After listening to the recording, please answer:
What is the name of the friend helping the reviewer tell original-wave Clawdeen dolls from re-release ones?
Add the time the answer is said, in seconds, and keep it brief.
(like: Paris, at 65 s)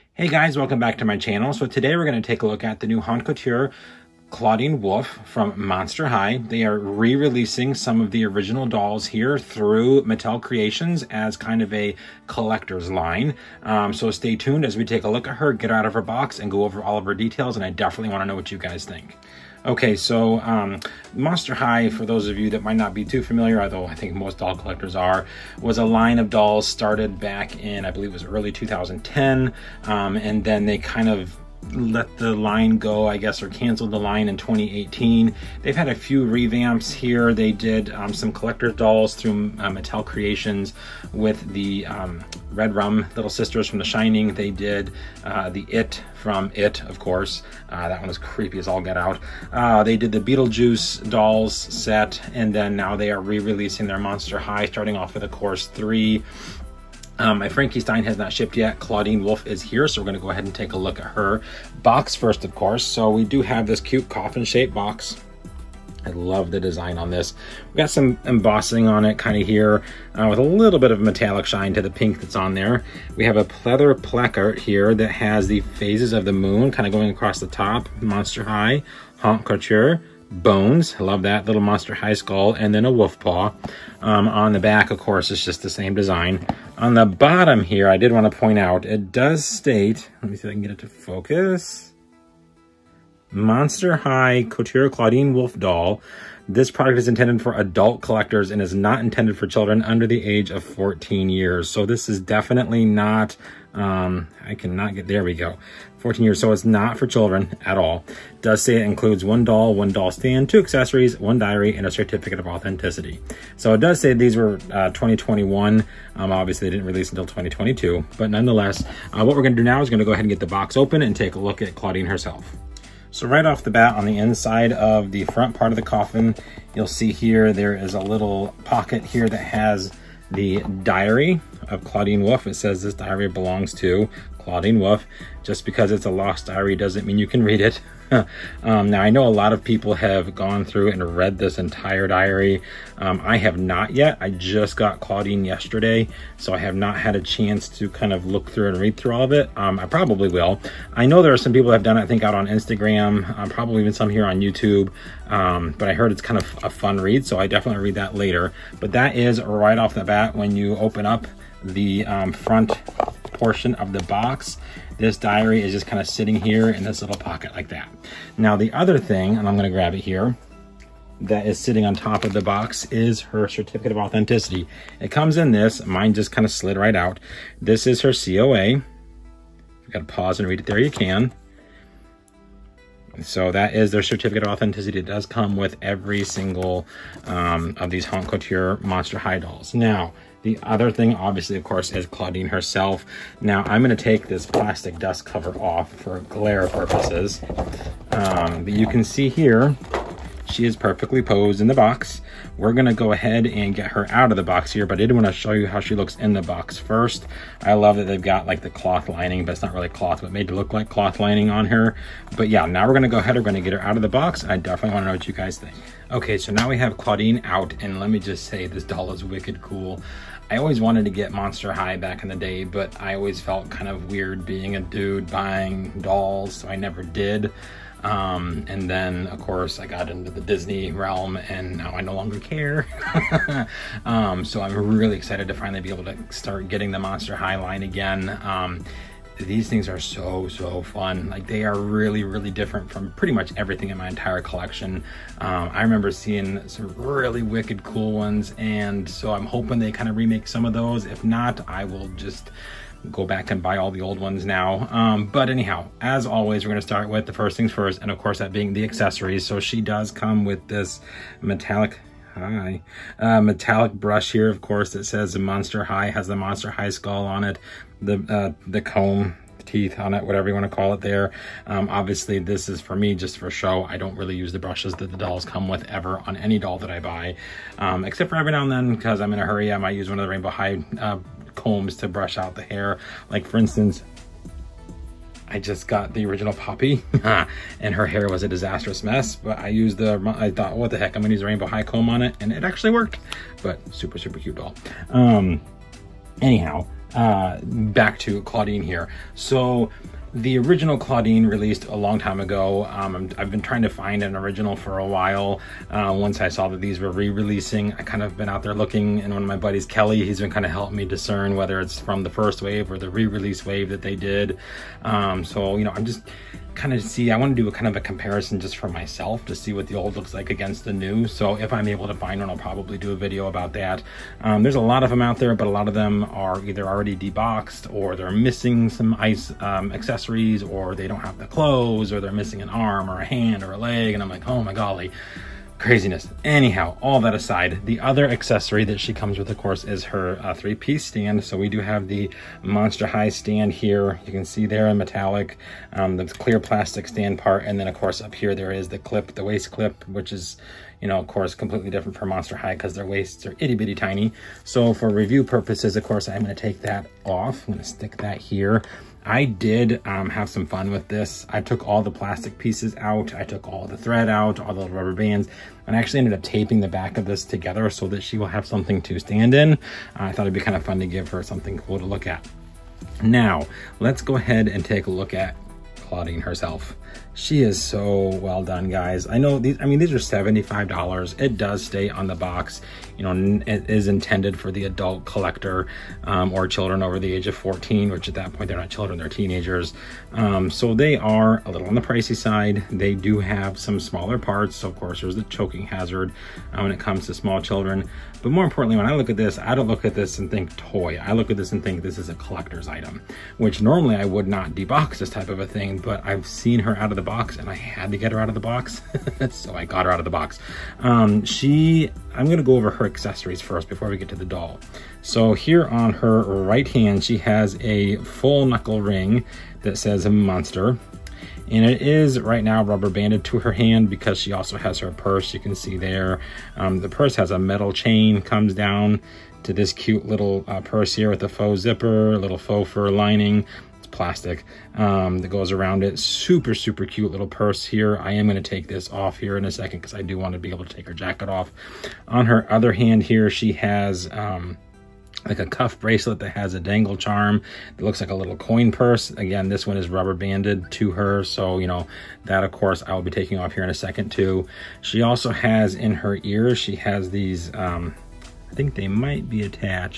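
Kelly, at 309 s.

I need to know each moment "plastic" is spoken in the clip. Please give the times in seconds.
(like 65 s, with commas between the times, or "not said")
194 s, 346 s, 362 s, 434 s.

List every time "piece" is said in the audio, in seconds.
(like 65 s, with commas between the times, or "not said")
340 s, 362 s.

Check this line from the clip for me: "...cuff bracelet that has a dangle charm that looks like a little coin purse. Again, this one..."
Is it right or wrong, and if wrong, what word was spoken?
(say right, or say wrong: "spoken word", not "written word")
right.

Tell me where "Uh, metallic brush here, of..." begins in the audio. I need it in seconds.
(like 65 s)
263 s.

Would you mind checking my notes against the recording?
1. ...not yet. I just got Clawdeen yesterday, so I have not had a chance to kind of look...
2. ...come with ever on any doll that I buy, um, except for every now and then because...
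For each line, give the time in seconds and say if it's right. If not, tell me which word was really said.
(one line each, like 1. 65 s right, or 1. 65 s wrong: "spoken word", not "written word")
1. 143 s right
2. 275 s right.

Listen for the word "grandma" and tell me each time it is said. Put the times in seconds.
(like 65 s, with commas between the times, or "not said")
not said.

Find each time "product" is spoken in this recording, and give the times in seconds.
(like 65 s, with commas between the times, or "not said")
96 s.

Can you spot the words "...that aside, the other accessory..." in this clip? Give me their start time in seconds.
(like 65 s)
337 s.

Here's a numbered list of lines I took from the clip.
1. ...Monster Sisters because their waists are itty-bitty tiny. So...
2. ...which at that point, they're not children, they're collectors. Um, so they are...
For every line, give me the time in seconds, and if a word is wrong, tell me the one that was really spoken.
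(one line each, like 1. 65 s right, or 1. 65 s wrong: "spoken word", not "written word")
1. 352 s wrong: "High", not "Sisters"
2. 388 s wrong: "teenagers", not "collectors".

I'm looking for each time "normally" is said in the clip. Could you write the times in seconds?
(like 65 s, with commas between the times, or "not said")
403 s.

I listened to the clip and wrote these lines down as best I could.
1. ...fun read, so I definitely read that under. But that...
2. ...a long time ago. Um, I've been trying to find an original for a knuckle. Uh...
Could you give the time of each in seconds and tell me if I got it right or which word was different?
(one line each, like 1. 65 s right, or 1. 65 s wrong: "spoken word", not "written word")
1. 156 s wrong: "later", not "under"
2. 301 s wrong: "while", not "knuckle".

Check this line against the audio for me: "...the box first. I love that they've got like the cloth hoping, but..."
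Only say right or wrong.
wrong.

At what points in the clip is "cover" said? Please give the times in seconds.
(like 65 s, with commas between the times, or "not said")
195 s.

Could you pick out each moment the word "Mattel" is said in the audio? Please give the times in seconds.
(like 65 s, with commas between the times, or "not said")
10 s, 39 s.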